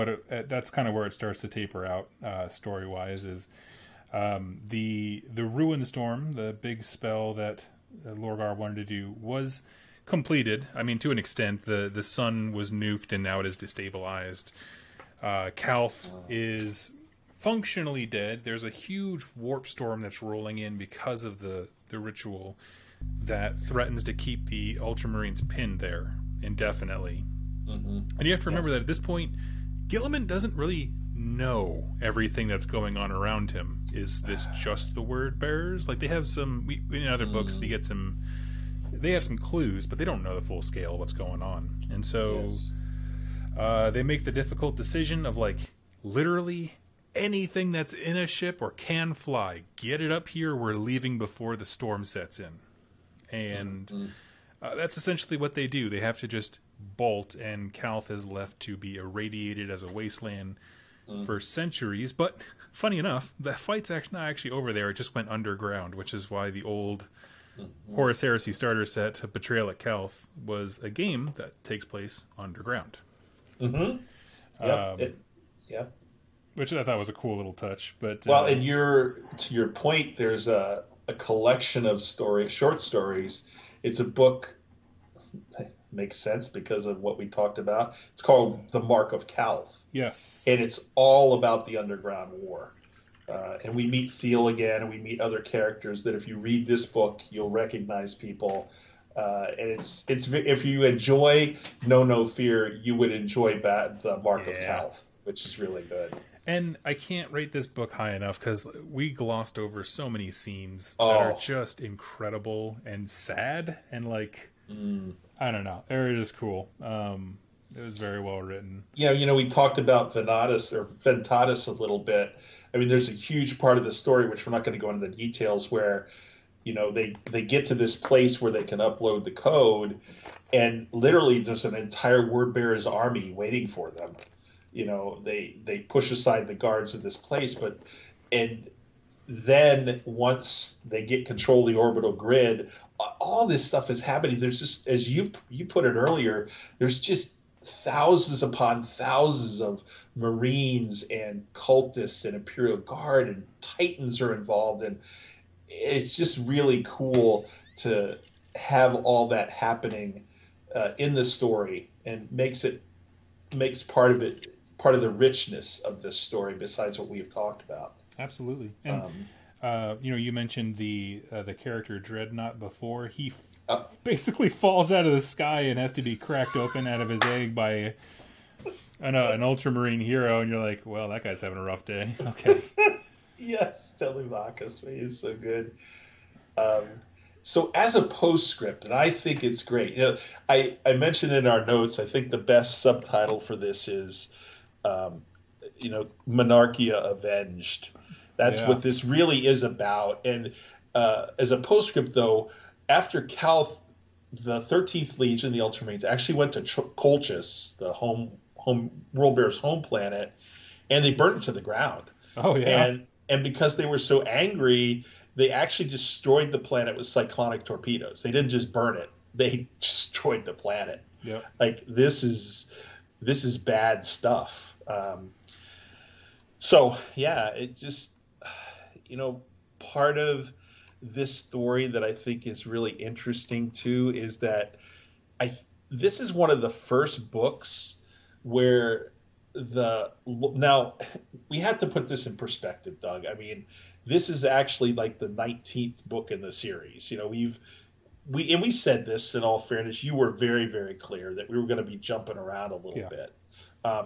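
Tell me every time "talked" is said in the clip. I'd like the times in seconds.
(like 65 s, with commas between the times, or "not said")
87 s, 119 s, 167 s.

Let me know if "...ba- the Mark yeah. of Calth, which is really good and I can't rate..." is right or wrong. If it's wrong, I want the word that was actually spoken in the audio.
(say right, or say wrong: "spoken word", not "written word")
right.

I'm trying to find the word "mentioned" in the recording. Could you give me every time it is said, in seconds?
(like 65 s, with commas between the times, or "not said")
170 s, 190 s.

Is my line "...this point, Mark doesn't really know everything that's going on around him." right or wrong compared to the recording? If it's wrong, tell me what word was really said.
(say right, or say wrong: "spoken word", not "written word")
wrong: "Guilliman", not "Mark".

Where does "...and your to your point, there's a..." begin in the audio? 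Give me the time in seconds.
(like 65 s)
78 s.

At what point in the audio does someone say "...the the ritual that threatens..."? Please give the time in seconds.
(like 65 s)
21 s.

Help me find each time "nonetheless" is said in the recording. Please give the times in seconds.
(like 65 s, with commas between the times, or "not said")
not said.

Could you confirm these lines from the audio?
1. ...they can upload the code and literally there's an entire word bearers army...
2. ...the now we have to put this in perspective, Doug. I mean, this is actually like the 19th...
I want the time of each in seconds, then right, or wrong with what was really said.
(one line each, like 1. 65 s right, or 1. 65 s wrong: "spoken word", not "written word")
1. 128 s right
2. 239 s right.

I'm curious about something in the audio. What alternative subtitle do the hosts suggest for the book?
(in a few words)
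Monarchia avenged.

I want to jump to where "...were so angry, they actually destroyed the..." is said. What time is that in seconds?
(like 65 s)
213 s.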